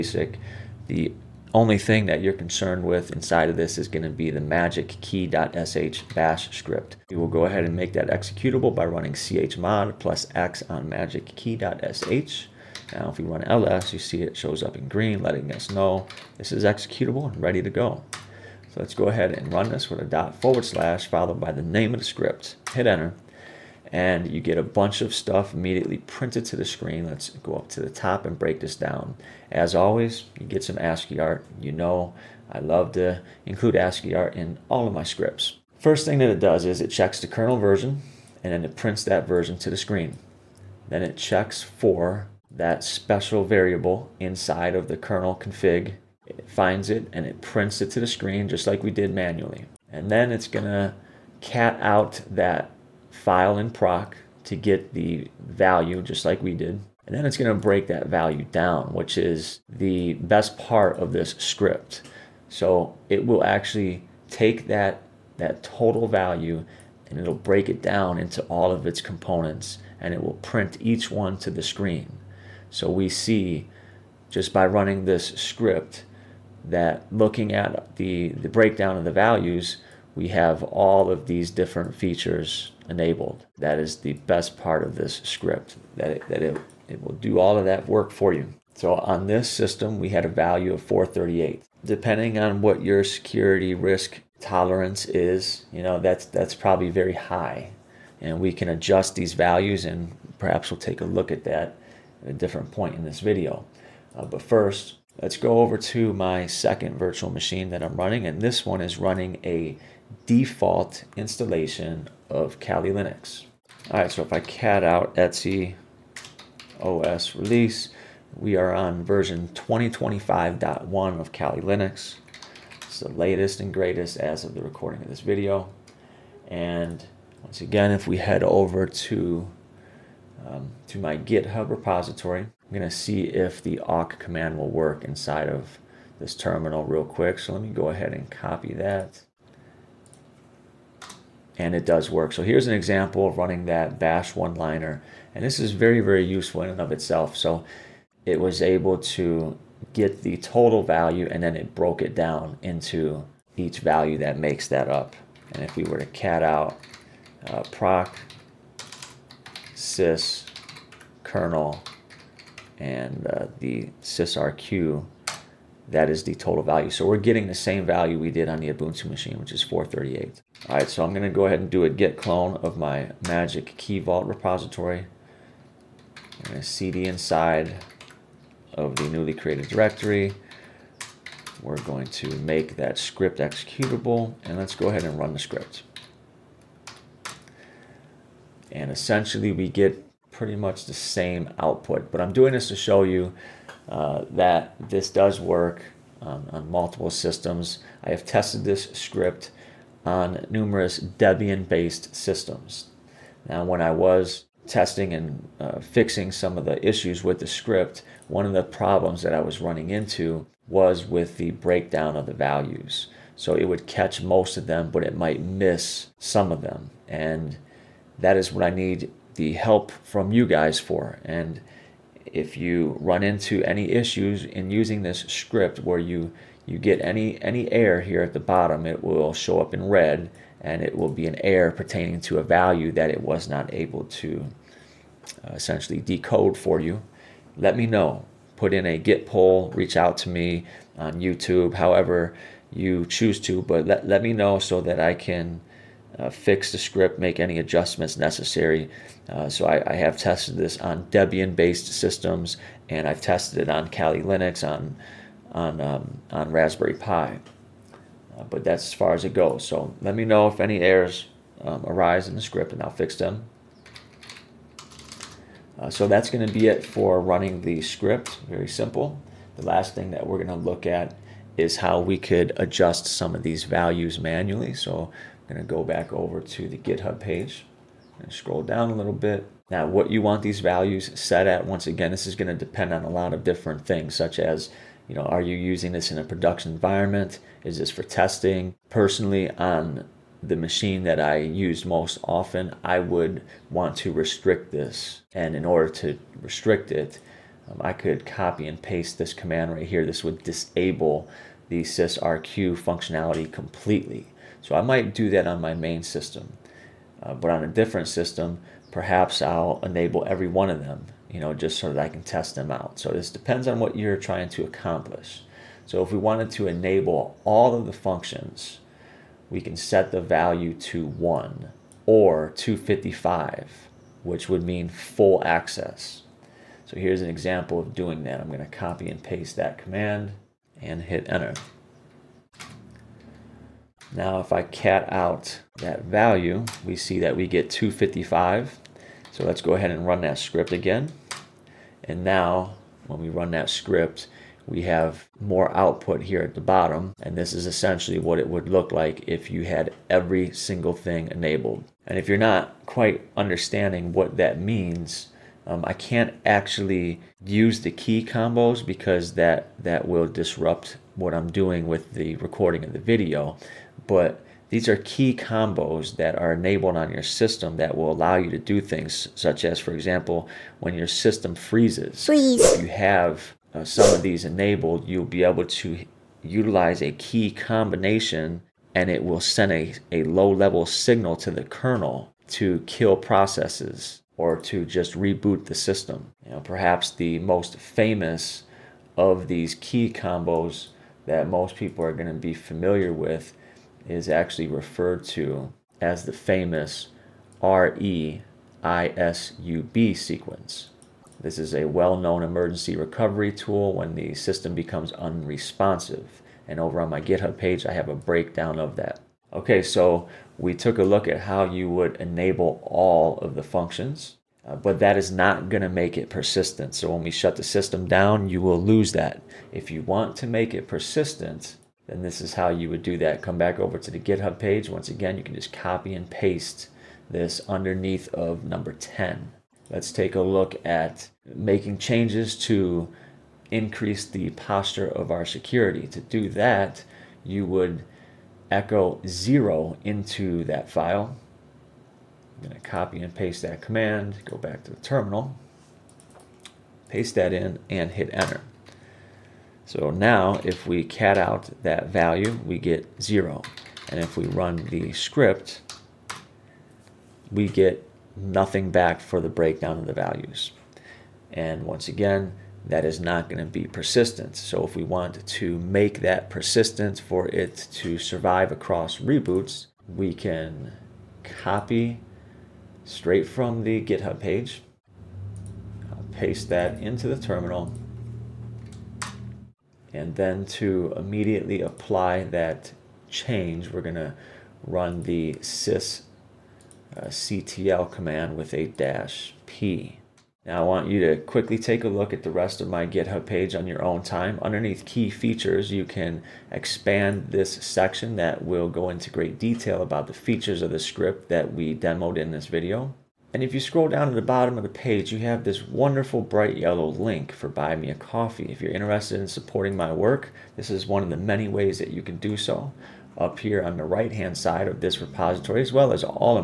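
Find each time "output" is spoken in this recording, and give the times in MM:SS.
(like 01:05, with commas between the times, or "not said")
03:11, 05:45.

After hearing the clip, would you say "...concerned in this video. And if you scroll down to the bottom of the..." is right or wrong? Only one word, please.
wrong.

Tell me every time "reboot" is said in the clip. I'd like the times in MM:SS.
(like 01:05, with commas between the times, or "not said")
06:25, 07:49.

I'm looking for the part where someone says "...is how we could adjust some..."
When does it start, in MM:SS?
04:31.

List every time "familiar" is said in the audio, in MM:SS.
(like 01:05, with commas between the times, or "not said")
06:32.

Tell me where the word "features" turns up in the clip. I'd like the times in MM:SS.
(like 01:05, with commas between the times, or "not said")
01:21, 08:15, 08:20.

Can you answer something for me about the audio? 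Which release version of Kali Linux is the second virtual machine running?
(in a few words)
2025.1.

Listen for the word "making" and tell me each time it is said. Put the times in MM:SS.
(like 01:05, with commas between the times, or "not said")
07:11.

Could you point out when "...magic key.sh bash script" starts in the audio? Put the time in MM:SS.
00:04.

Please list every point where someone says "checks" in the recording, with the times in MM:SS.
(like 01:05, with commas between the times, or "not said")
00:36, 00:41.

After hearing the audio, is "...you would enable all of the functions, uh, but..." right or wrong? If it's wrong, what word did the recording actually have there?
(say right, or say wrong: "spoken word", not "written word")
right.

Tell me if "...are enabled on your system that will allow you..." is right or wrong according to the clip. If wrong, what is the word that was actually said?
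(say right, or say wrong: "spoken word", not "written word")
right.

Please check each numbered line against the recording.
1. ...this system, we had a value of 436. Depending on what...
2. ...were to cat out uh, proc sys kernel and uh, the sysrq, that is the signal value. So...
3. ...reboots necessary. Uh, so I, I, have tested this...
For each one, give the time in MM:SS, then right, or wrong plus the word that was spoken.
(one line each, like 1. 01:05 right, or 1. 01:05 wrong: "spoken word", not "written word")
1. 01:29 wrong: "438", not "436"
2. 02:35 wrong: "total", not "signal"
3. 04:07 wrong: "adjustments", not "reboots".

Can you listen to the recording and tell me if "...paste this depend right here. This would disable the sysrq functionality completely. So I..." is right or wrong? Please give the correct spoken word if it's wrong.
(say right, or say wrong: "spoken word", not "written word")
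wrong: "command", not "depend".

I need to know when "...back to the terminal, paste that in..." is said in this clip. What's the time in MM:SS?
07:24.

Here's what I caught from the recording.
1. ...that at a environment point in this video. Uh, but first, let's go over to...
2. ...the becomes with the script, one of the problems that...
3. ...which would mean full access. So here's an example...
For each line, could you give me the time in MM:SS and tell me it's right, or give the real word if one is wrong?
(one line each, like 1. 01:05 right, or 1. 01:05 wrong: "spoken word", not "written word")
1. 01:41 wrong: "different", not "environment"
2. 03:26 wrong: "issues", not "becomes"
3. 05:24 right.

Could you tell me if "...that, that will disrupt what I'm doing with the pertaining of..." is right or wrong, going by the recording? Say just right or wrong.
wrong.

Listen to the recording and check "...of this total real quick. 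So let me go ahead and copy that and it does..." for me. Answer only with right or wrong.
wrong.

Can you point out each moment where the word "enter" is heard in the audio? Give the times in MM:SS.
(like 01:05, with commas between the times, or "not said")
00:22, 05:31, 07:28.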